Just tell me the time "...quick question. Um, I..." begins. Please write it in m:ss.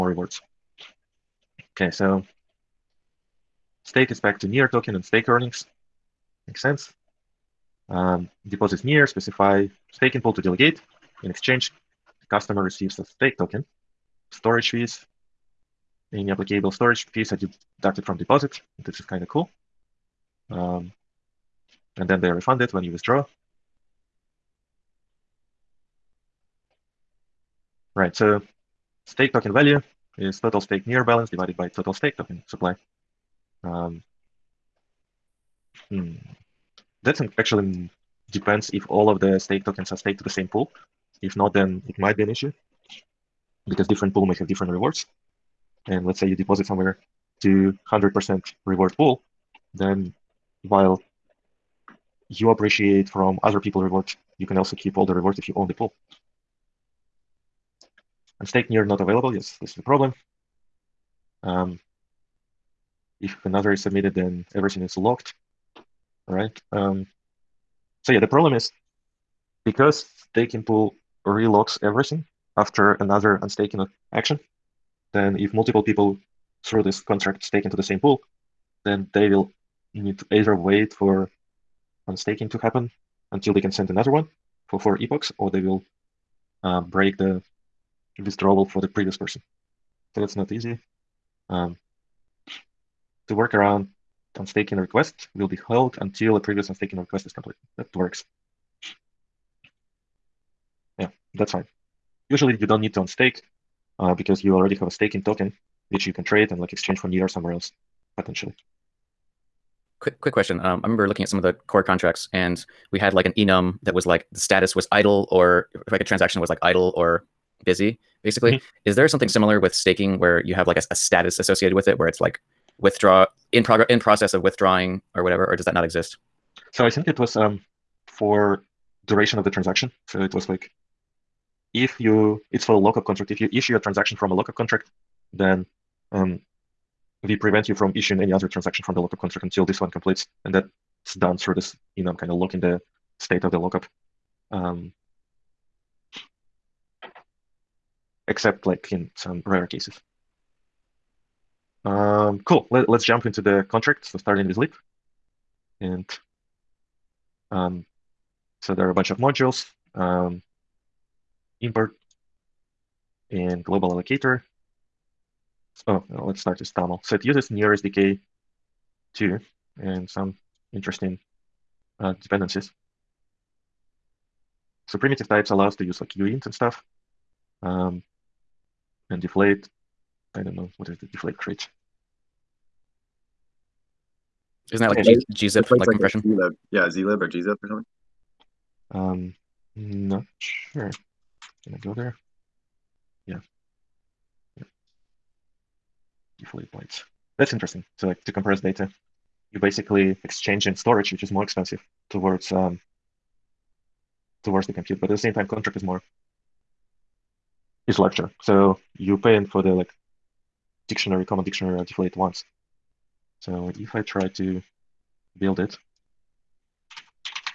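1:50.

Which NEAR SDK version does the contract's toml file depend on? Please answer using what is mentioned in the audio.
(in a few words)
2.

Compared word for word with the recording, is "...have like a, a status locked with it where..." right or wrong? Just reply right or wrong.
wrong.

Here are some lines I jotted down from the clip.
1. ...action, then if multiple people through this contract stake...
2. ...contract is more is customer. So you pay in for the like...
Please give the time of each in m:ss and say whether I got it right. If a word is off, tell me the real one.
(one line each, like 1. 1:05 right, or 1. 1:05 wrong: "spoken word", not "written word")
1. 1:14 right
2. 3:25 wrong: "larger", not "customer".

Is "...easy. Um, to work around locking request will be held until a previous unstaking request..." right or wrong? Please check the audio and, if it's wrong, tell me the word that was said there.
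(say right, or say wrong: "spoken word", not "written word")
wrong: "unstaking", not "locking".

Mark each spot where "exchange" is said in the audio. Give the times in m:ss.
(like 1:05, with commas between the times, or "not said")
0:11, 1:46, 3:20.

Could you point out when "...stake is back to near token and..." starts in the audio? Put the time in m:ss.
0:03.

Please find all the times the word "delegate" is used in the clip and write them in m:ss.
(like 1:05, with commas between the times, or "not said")
0:10.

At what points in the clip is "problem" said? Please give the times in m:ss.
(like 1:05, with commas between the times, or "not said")
0:59, 1:08.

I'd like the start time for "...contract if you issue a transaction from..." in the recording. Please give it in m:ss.
2:13.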